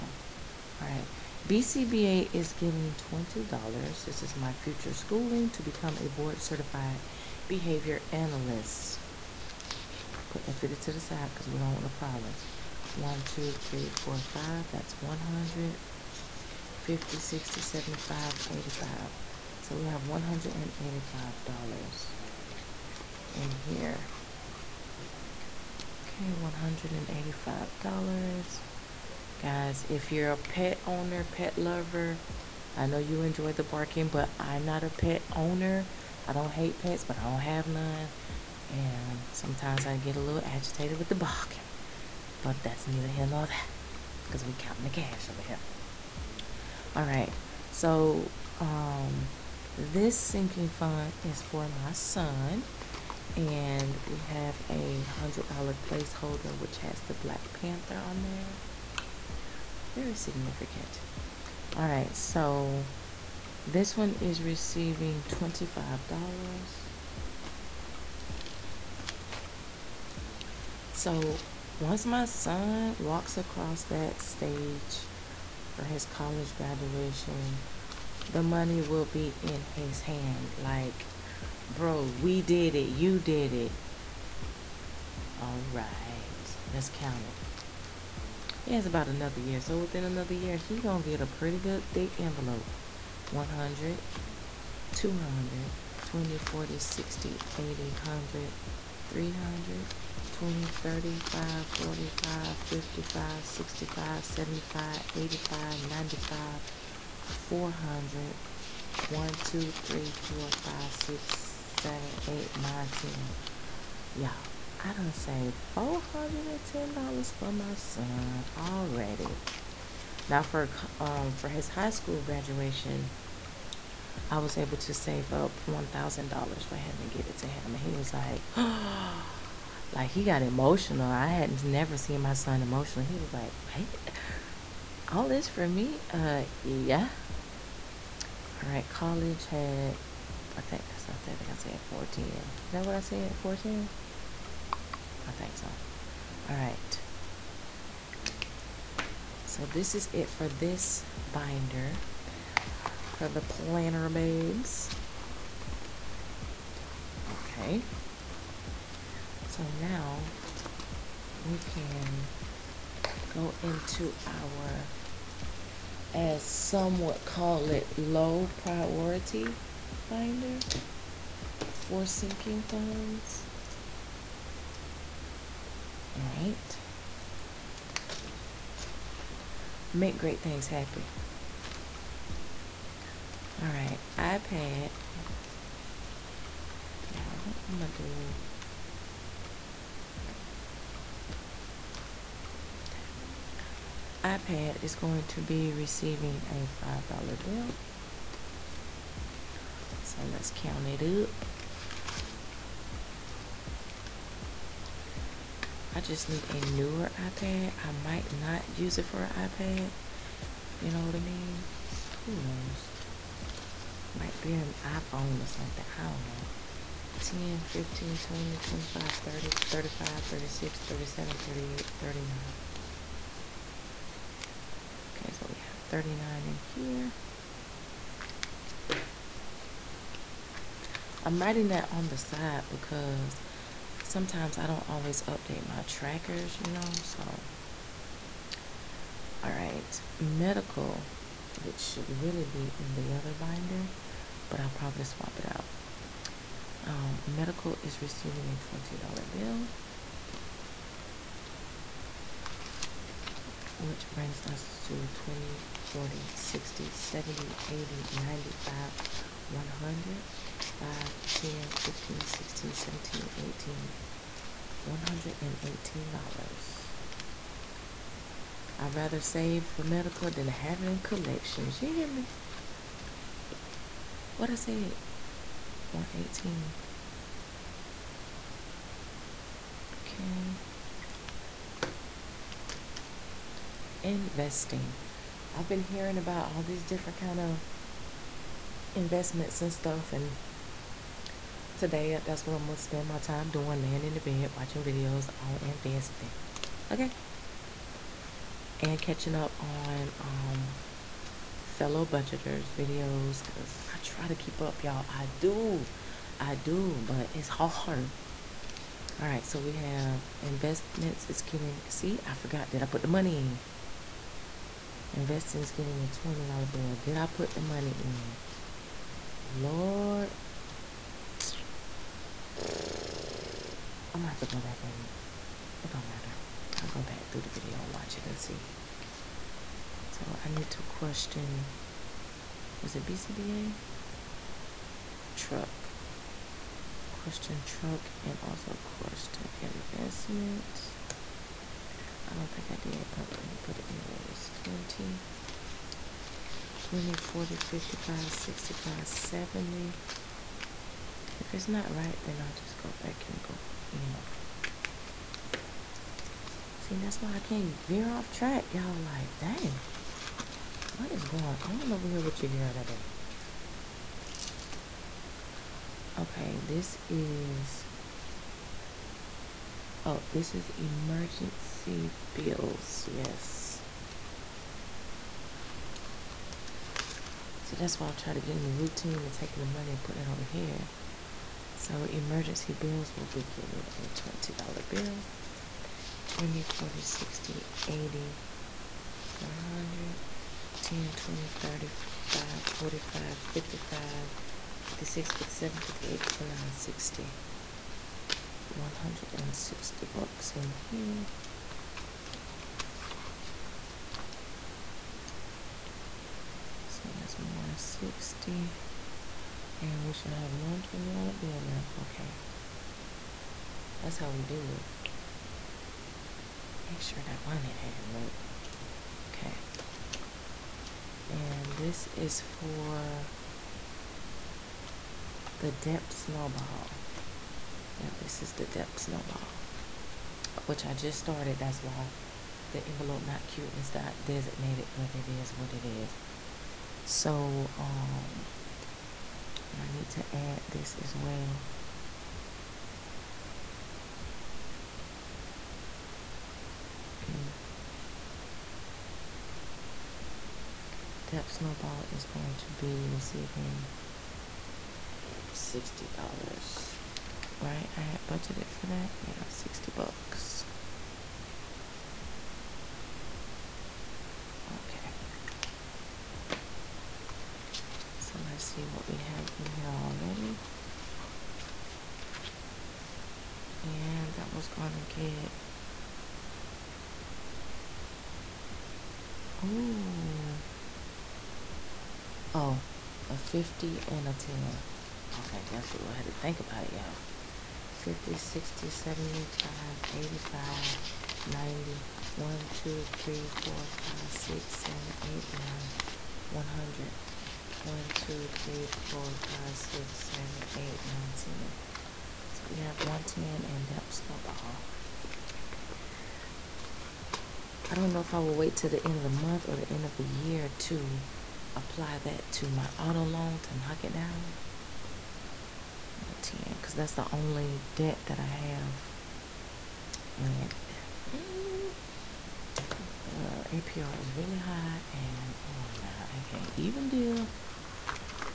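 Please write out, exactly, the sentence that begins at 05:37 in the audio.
Question truck and also question investment.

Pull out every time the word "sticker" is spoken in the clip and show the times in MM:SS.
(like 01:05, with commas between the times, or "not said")
not said.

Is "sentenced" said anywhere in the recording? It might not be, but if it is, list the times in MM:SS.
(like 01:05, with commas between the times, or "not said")
not said.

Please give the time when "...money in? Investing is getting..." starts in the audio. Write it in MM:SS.
05:13.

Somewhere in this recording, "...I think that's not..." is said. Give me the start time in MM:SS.
02:20.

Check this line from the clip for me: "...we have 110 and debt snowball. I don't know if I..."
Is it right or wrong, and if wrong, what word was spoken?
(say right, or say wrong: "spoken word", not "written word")
right.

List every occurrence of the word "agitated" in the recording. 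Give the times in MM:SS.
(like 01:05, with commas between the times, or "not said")
00:40.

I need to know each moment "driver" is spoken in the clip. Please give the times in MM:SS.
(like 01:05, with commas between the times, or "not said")
not said.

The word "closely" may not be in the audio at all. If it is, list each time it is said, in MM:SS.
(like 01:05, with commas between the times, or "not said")
not said.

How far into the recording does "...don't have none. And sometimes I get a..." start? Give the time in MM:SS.
00:37.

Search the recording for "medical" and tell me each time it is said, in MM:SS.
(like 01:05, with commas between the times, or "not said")
04:00, 04:29.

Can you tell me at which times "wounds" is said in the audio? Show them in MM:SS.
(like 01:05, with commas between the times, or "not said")
not said.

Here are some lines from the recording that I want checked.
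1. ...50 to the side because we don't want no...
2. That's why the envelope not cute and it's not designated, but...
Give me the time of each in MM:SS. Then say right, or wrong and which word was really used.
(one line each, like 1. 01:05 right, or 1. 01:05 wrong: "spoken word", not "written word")
1. 00:10 right
2. 07:11 right.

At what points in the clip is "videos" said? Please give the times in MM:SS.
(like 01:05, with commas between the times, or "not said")
04:54, 05:02, 05:27.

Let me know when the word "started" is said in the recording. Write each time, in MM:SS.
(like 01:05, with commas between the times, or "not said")
07:11.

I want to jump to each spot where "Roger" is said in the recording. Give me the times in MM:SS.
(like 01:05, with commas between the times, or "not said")
not said.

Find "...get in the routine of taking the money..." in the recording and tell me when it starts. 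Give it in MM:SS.
06:18.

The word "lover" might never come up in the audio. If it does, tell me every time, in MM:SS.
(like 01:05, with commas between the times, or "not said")
00:31.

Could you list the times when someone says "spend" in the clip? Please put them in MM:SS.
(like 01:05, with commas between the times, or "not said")
04:52.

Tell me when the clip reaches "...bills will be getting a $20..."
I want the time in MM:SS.
06:22.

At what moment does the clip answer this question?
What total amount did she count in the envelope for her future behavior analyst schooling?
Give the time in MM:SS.
00:20.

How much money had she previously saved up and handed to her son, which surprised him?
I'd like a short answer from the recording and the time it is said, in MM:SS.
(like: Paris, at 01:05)
$1,000, at 02:05.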